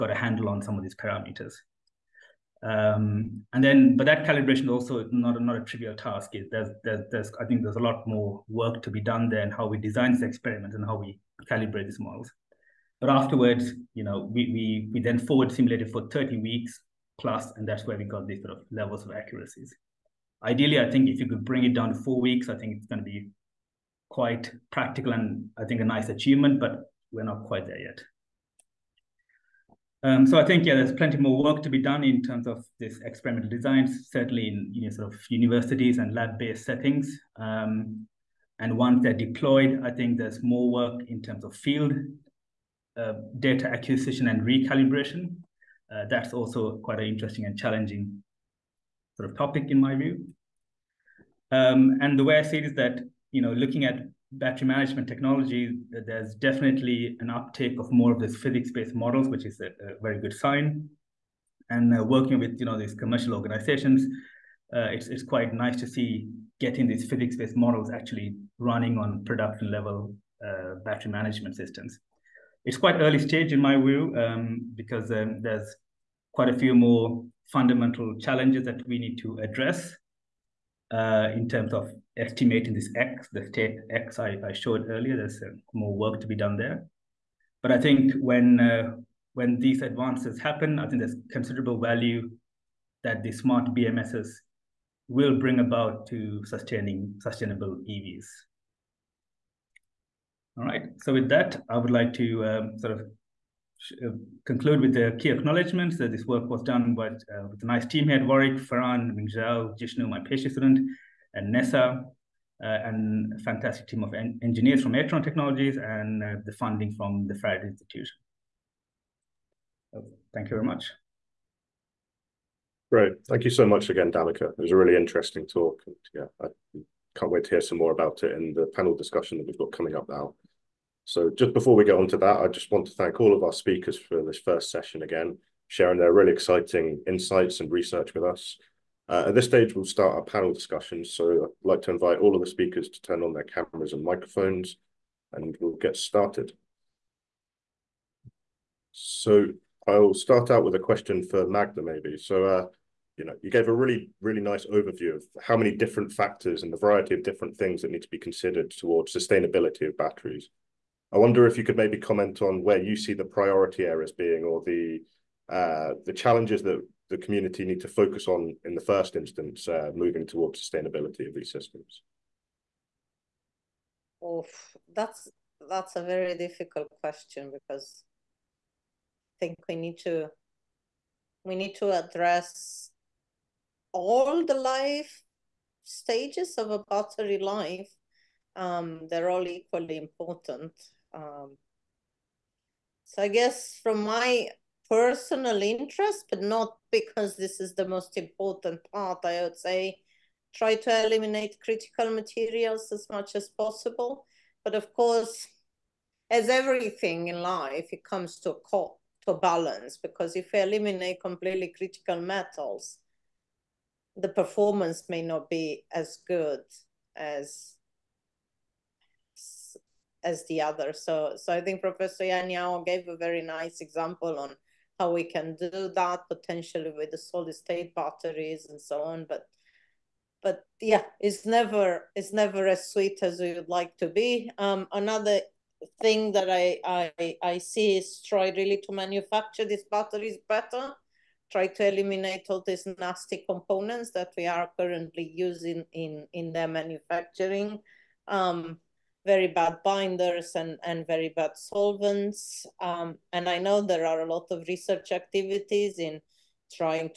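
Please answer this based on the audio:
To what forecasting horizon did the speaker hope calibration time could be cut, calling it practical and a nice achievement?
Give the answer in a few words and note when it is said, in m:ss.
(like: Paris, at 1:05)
4 weeks, at 0:21.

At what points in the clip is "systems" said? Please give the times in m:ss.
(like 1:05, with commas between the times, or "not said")
1:11, 2:51.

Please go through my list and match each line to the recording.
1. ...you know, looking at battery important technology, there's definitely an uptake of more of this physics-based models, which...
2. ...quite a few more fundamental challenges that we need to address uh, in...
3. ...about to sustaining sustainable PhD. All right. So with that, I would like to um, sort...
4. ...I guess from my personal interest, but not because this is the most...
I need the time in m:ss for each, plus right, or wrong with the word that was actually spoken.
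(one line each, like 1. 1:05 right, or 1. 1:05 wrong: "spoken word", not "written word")
1. 0:53 wrong: "management", not "important"
2. 1:16 right
3. 1:35 wrong: "EVs", not "PhD"
4. 3:13 right.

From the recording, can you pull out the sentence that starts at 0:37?
Um, and once they're deployed, I think there's more work in terms of field uh, data acquisition and recalibration.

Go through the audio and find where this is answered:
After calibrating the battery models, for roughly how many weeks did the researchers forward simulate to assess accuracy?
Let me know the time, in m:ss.
0:16.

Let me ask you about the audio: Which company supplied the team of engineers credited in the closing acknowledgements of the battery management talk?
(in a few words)
Eatron Technologies.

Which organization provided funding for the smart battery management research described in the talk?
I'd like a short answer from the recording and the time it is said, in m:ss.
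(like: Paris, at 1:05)
Faraday Institution, at 1:57.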